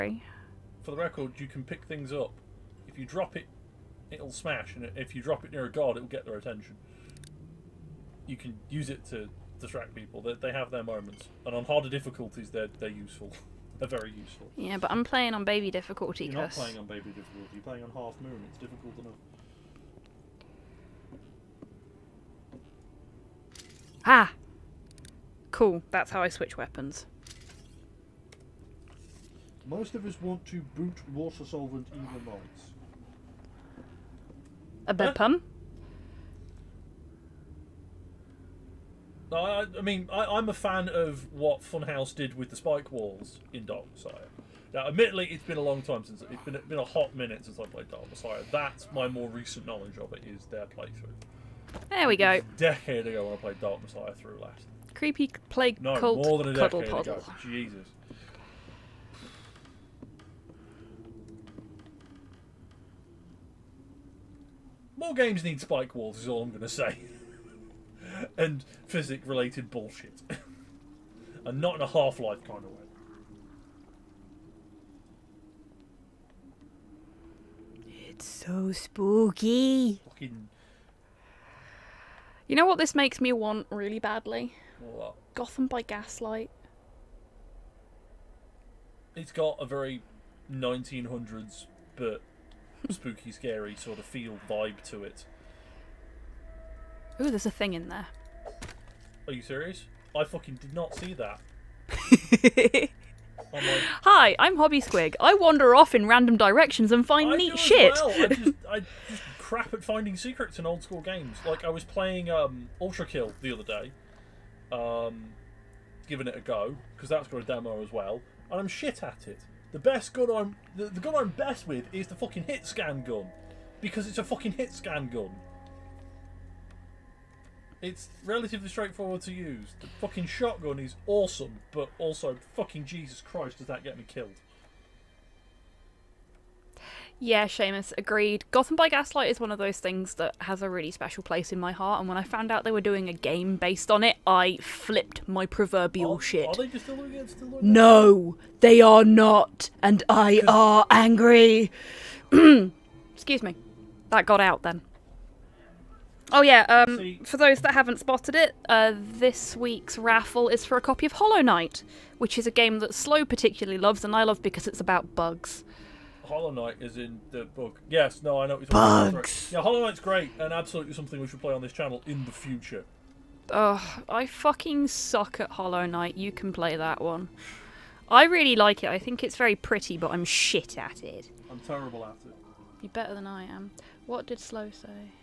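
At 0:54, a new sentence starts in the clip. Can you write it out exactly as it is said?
Creepy plague no, cult more than a cuddle decade Ago.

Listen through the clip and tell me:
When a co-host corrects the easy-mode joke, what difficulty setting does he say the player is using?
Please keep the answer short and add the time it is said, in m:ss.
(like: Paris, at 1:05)
Half moon, at 0:17.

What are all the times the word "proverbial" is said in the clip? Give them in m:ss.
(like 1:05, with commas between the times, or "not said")
2:25.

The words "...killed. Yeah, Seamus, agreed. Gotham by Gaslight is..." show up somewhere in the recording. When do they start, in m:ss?
2:14.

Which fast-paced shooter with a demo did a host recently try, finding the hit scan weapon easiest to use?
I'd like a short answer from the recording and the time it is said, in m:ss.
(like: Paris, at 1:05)
Ultrakill, at 1:52.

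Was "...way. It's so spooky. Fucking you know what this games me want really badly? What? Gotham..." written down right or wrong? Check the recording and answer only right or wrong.
wrong.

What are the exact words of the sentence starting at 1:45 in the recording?
I wander off in random directions and find I neat shit.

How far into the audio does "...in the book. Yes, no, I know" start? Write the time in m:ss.
2:46.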